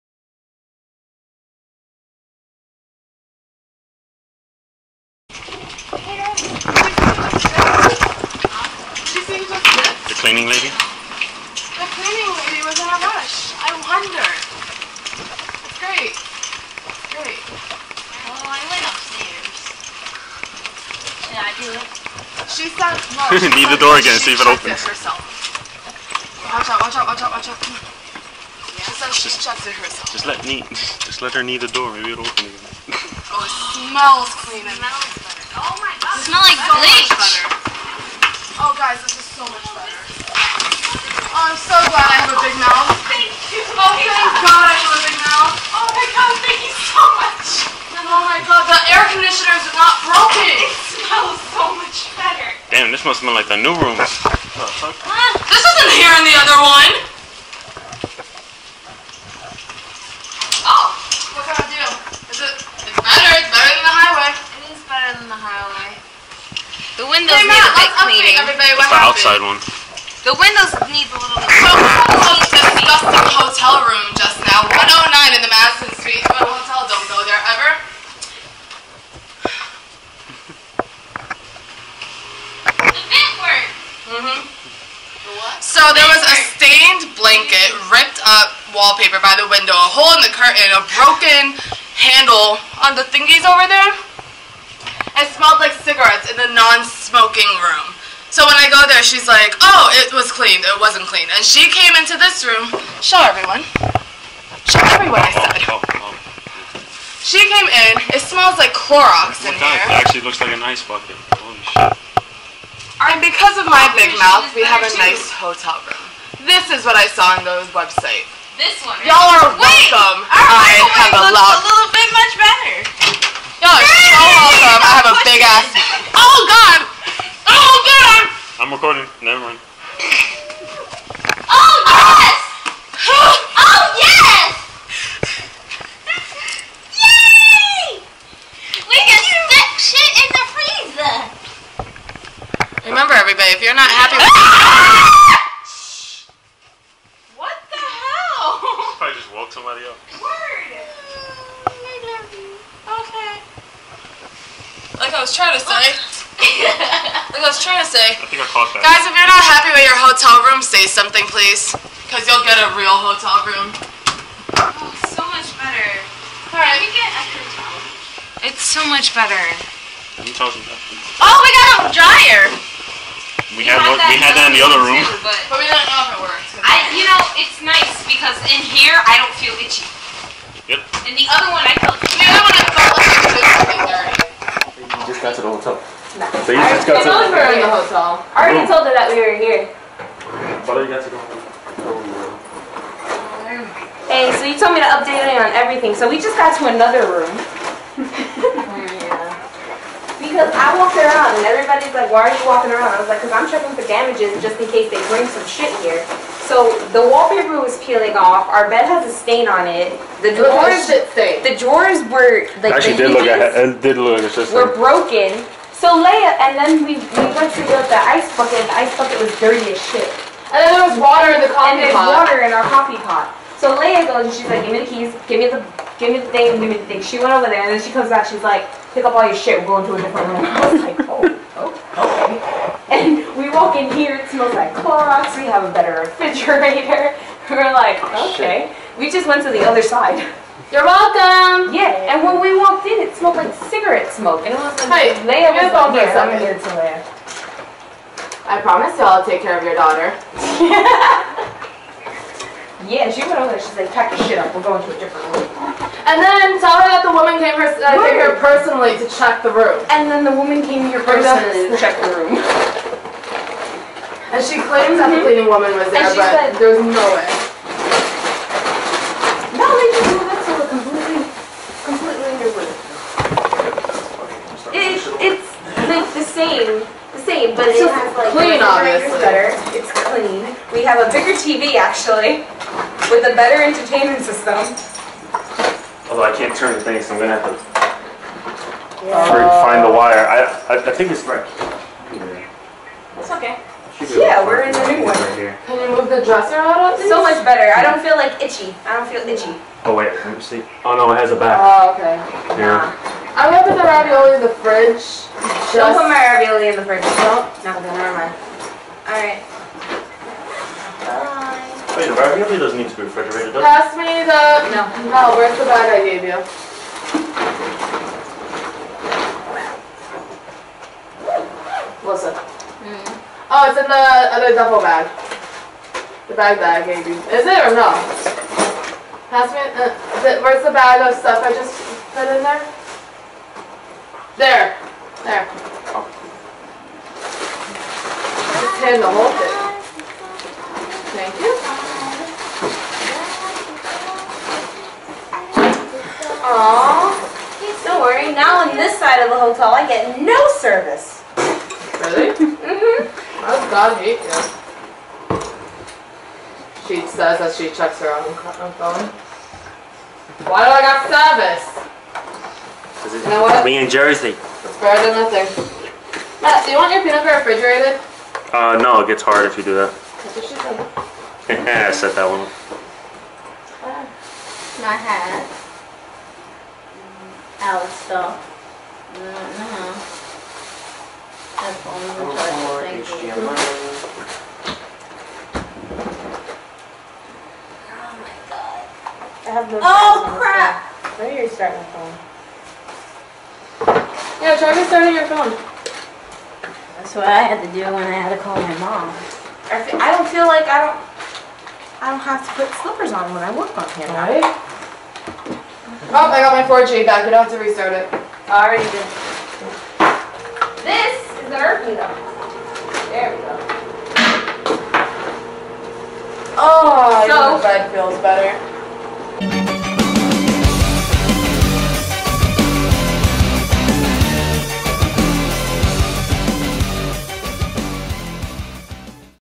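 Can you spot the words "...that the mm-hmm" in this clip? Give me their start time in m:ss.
4:24.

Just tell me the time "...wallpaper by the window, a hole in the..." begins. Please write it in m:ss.
1:28.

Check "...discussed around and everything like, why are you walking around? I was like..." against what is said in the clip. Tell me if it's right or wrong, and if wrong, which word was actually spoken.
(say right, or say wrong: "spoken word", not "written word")
wrong: "walked", not "discussed".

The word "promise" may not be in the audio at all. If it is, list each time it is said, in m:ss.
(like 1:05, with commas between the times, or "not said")
4:08.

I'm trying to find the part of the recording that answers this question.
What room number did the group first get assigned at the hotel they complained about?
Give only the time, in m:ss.
1:14.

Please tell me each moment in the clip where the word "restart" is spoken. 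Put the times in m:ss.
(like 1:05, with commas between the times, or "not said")
6:47.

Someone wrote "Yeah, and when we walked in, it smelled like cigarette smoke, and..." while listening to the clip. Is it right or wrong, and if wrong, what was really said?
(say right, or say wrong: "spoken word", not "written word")
right.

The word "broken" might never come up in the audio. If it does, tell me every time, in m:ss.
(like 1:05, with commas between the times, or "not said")
0:50, 1:30, 3:34.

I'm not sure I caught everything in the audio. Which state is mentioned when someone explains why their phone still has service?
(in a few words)
Jersey.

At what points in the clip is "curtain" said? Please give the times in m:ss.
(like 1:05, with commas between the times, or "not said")
1:30.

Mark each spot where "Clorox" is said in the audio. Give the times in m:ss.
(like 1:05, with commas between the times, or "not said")
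1:48, 3:54.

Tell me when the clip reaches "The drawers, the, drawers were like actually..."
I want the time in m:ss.
3:30.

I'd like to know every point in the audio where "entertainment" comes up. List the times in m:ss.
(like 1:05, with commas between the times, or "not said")
4:43.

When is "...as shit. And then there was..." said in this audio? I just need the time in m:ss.
3:39.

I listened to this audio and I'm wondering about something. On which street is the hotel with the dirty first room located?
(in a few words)
Madison Street.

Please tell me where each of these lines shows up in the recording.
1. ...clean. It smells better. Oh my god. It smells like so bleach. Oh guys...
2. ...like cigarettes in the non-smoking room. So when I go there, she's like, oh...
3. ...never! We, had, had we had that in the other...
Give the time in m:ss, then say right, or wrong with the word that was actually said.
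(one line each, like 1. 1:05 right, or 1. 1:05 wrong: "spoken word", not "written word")
1. 0:34 right
2. 1:35 right
3. 2:51 wrong: "dryer", not "never".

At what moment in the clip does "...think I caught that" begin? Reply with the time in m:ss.
2:38.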